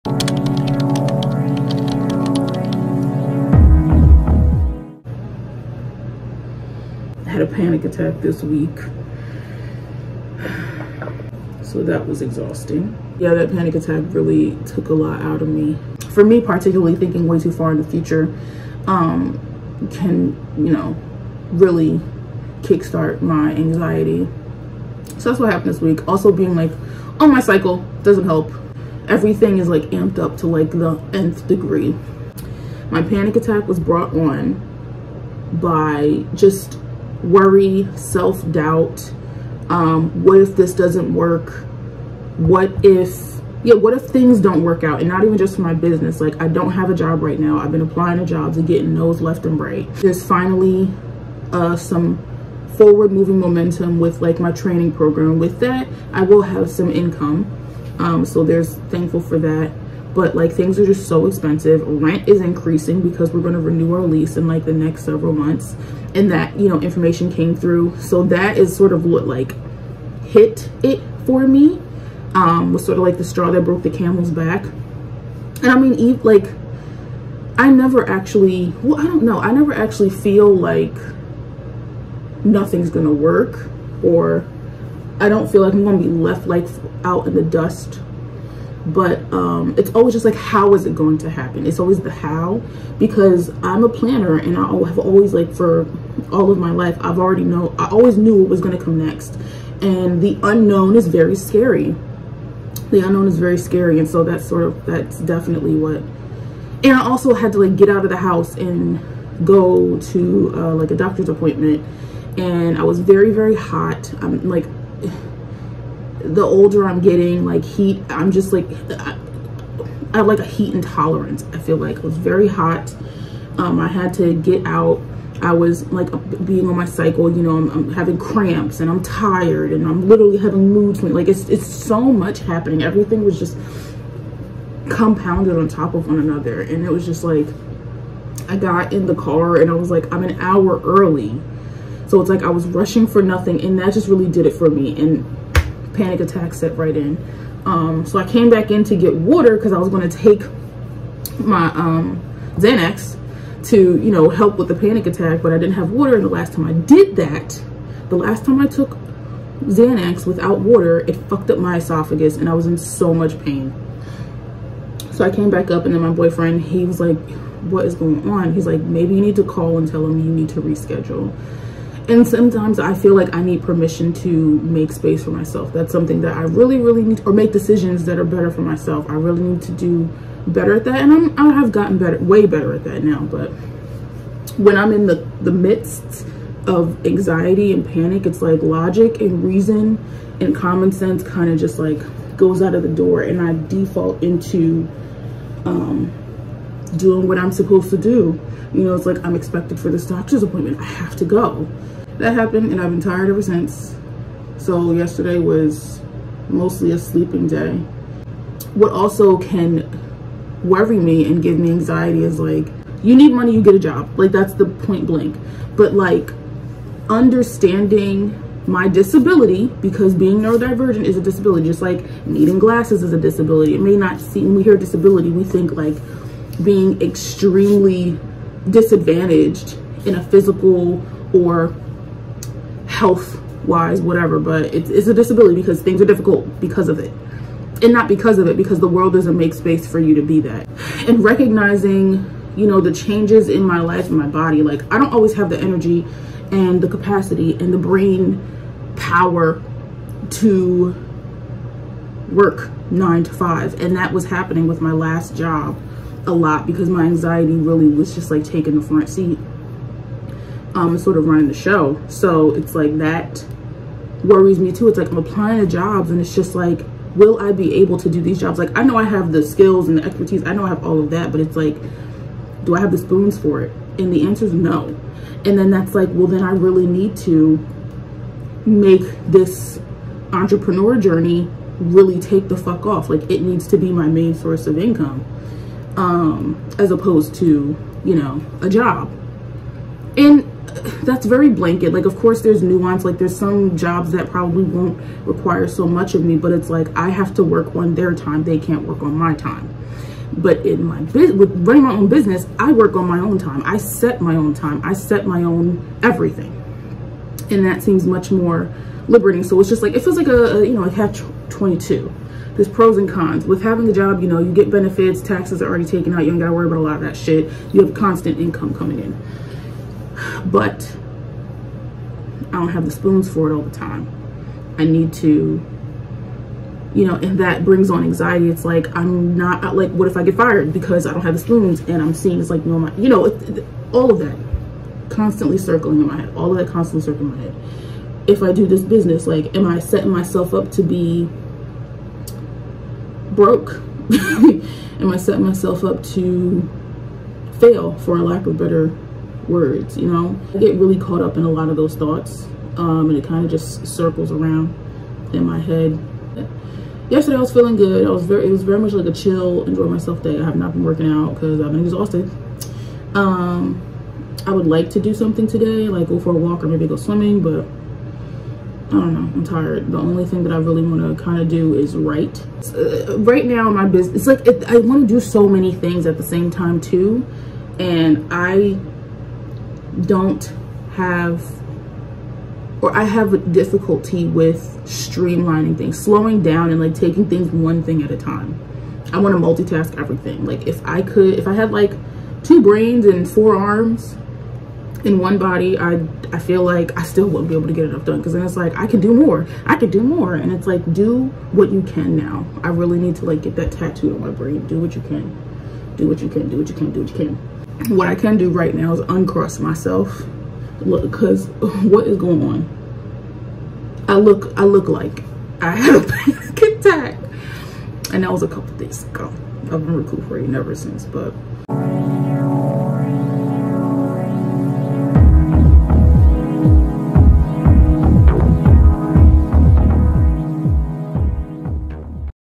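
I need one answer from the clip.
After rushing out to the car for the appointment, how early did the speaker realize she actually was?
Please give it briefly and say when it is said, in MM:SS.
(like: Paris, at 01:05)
an hour, at 02:20.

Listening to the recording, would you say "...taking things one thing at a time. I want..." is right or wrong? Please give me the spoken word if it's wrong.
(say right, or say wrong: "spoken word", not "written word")
right.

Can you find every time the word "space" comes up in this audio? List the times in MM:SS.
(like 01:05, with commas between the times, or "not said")
02:54, 03:59.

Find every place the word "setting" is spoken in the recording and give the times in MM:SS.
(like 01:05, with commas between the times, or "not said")
05:39, 05:45.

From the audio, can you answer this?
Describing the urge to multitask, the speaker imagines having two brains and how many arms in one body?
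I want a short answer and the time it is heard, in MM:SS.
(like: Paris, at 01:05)
4, at 06:33.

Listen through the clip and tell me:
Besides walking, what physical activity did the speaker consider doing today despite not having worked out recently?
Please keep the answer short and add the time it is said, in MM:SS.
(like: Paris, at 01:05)
swimming, at 06:06.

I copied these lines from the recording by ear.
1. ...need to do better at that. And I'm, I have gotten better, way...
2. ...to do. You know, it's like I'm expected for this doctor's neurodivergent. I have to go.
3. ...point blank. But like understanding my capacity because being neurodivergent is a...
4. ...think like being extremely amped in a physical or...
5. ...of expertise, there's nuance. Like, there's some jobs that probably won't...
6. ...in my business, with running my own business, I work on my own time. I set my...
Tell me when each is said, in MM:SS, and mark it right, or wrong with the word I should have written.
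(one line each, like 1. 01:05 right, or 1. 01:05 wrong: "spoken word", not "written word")
1. 02:59 right
2. 03:17 wrong: "appointment", not "neurodivergent"
3. 03:34 wrong: "disability", not "capacity"
4. 03:45 wrong: "disadvantaged", not "amped"
5. 04:52 wrong: "course", not "expertise"
6. 05:00 right.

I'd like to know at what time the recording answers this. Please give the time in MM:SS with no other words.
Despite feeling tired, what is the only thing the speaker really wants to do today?
06:11.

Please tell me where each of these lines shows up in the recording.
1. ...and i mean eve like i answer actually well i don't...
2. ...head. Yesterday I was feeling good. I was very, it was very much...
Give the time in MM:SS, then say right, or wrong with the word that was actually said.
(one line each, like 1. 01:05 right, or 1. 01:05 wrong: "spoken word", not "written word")
1. 01:14 wrong: "never", not "answer"
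2. 05:55 right.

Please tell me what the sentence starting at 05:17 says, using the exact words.
You have constant income coming in.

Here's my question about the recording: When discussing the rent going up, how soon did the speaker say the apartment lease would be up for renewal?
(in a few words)
next several months.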